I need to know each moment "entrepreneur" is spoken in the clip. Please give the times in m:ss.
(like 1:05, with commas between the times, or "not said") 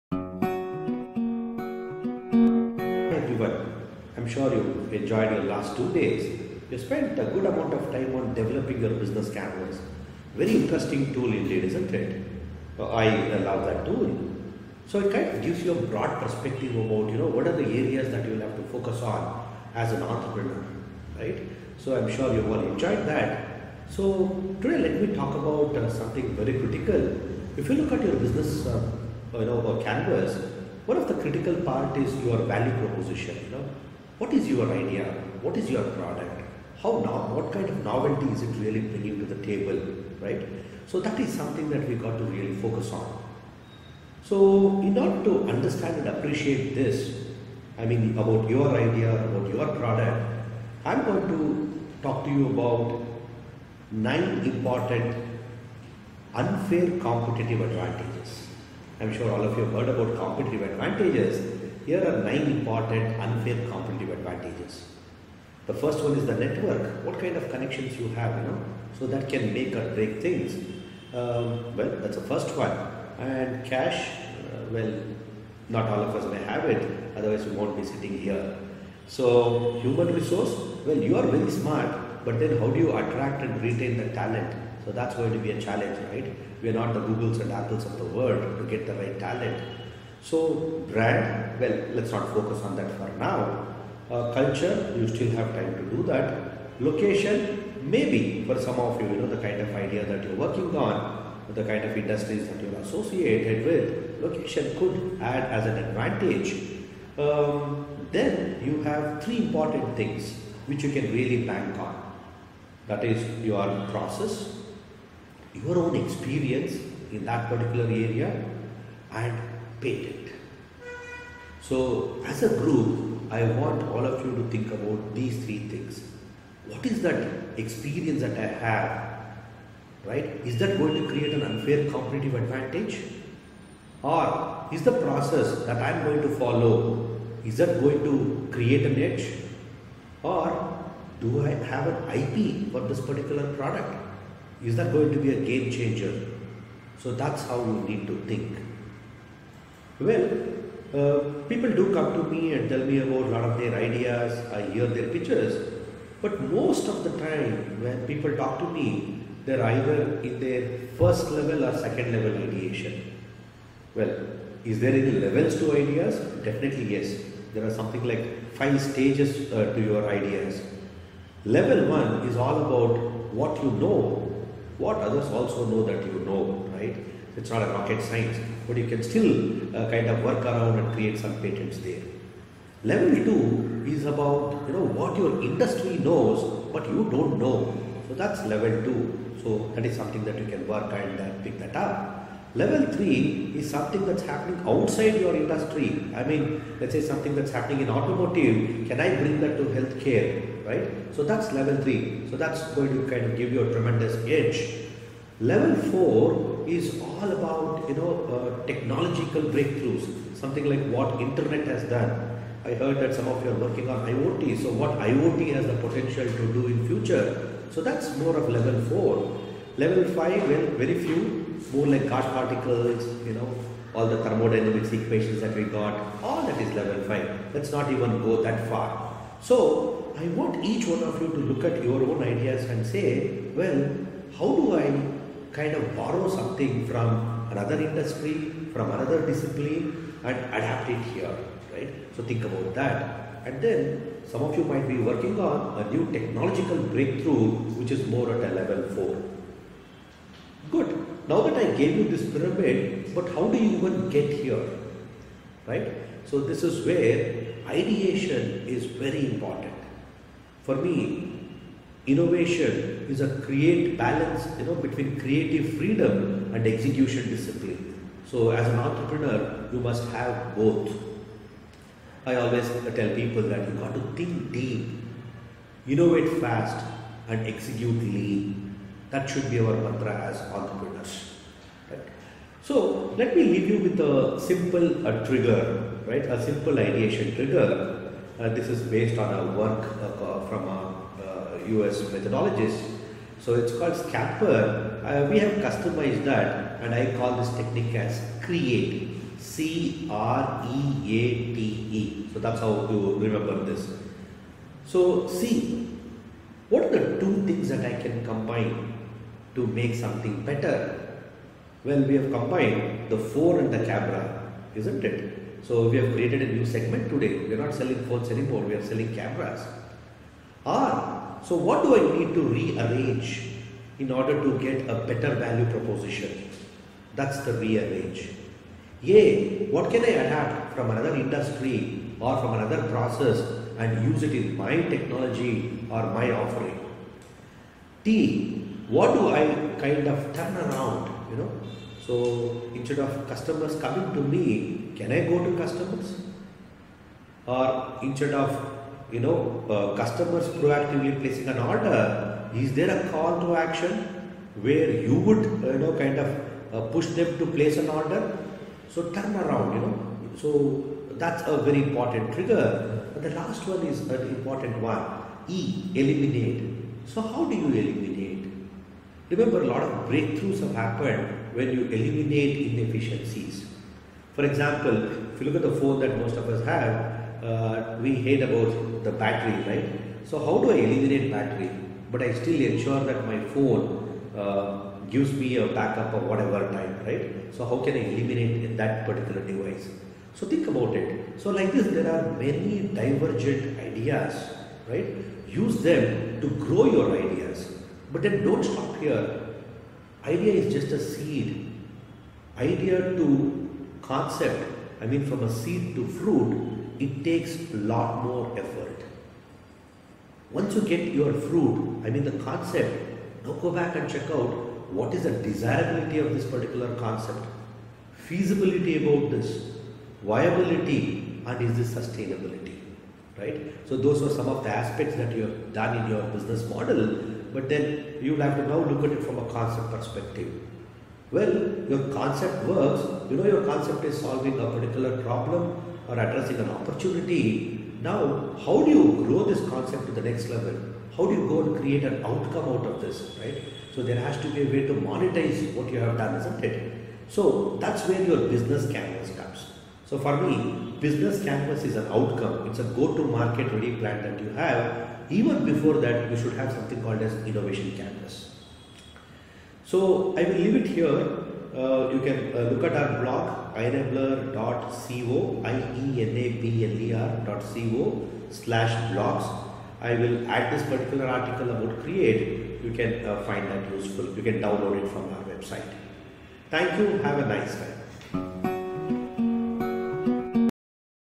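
0:20, 4:28, 4:40.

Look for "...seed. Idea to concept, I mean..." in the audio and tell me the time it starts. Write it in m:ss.
6:40.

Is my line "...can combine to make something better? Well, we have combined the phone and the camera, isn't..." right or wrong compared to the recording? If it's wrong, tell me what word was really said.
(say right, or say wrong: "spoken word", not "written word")
right.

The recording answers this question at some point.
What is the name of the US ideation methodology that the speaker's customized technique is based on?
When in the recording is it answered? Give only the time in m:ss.
4:53.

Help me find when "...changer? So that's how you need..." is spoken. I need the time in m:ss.
2:25.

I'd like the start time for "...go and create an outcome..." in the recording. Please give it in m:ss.
7:21.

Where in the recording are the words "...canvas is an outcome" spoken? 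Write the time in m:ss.
7:31.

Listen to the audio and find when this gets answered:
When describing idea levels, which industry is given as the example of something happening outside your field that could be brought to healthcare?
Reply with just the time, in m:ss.
3:17.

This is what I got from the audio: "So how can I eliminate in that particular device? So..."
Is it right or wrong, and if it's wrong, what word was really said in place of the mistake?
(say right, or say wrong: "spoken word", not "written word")
right.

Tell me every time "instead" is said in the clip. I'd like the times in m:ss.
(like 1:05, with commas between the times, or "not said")
5:42, 5:48.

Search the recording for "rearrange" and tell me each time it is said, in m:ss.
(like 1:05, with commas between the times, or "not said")
5:22, 5:27.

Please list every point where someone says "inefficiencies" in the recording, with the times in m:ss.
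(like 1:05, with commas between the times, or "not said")
6:12.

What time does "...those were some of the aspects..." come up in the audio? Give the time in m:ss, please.
7:03.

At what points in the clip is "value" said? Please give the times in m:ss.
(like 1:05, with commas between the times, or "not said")
0:32, 5:25.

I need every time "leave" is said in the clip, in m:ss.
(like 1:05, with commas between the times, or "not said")
4:43, 7:40.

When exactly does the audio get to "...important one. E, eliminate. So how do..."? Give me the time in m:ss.
6:04.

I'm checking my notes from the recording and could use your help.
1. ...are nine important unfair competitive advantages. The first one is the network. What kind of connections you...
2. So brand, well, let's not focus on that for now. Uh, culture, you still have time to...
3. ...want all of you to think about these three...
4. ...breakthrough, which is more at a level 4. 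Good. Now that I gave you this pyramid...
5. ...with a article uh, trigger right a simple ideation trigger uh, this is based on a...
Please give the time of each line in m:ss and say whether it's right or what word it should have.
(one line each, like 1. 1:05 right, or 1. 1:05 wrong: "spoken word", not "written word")
1. 1:02 right
2. 1:30 right
3. 2:03 right
4. 4:06 right
5. 4:43 wrong: "simple", not "article".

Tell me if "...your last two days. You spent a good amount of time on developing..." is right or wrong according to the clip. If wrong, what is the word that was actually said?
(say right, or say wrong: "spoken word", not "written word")
right.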